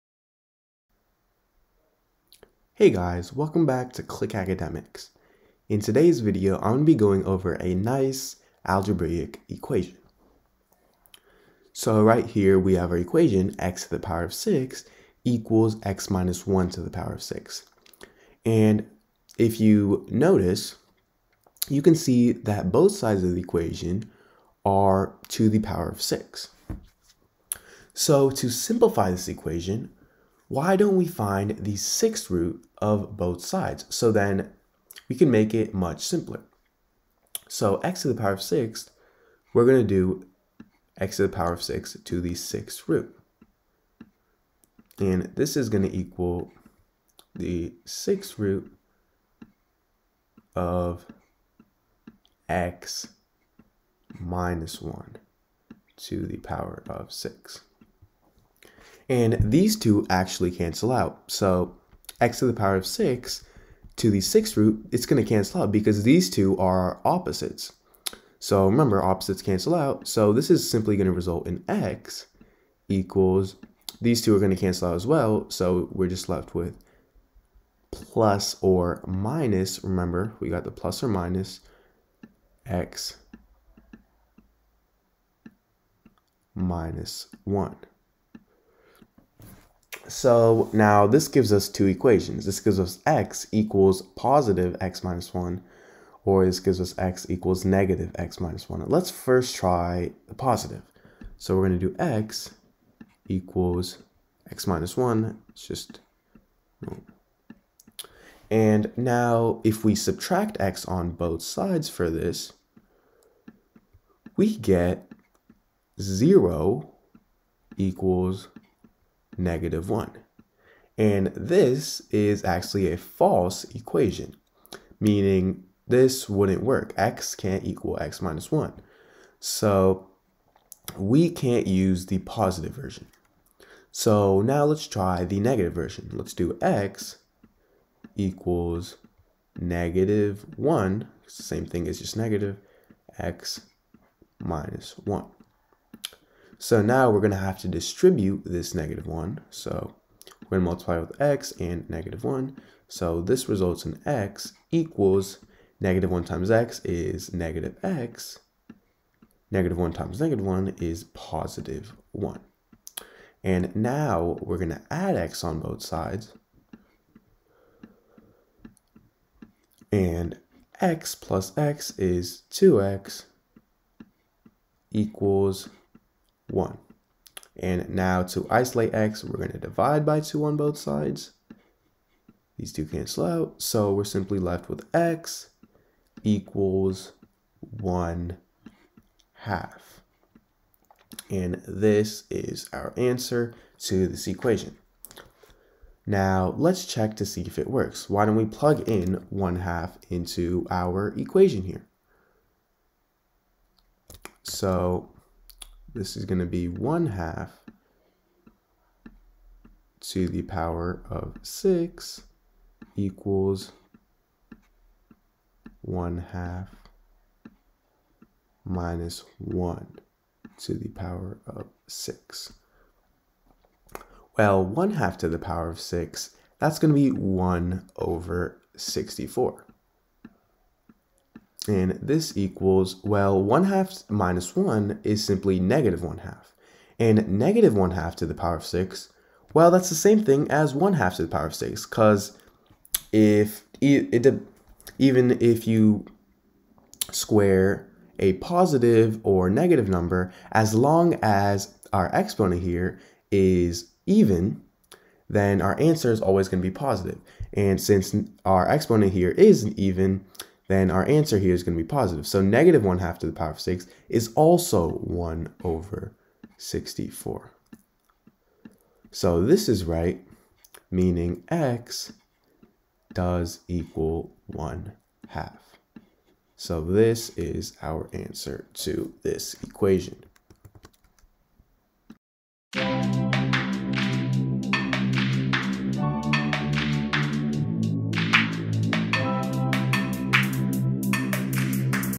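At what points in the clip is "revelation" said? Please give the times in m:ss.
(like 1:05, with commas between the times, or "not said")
not said.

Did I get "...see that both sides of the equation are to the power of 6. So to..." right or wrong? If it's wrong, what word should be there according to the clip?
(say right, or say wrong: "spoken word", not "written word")
right.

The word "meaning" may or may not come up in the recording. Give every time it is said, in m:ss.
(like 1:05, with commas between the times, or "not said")
2:04, 4:30.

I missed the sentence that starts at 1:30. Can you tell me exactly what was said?
So now this gives us two equations.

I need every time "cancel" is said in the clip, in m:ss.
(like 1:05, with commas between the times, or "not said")
1:00, 1:05, 1:09, 1:14, 3:02.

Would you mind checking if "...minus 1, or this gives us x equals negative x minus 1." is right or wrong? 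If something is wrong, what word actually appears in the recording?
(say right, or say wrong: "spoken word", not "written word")
right.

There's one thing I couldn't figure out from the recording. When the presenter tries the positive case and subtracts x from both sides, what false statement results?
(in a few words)
0 = -1.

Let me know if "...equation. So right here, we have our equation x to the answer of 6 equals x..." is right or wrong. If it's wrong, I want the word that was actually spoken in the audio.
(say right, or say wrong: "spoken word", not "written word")
wrong: "power", not "answer".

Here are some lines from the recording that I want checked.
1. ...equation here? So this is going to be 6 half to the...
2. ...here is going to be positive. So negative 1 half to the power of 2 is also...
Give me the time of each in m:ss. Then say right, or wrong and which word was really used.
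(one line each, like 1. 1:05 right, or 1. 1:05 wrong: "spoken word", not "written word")
1. 3:21 wrong: "1", not "6"
2. 4:21 wrong: "6", not "2".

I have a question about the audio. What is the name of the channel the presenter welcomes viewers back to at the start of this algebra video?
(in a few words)
Click Academics.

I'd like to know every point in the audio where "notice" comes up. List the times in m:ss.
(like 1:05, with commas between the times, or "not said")
0:20.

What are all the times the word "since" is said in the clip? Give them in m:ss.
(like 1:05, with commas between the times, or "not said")
4:17.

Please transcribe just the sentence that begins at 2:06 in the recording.
x can't equal x minus 1.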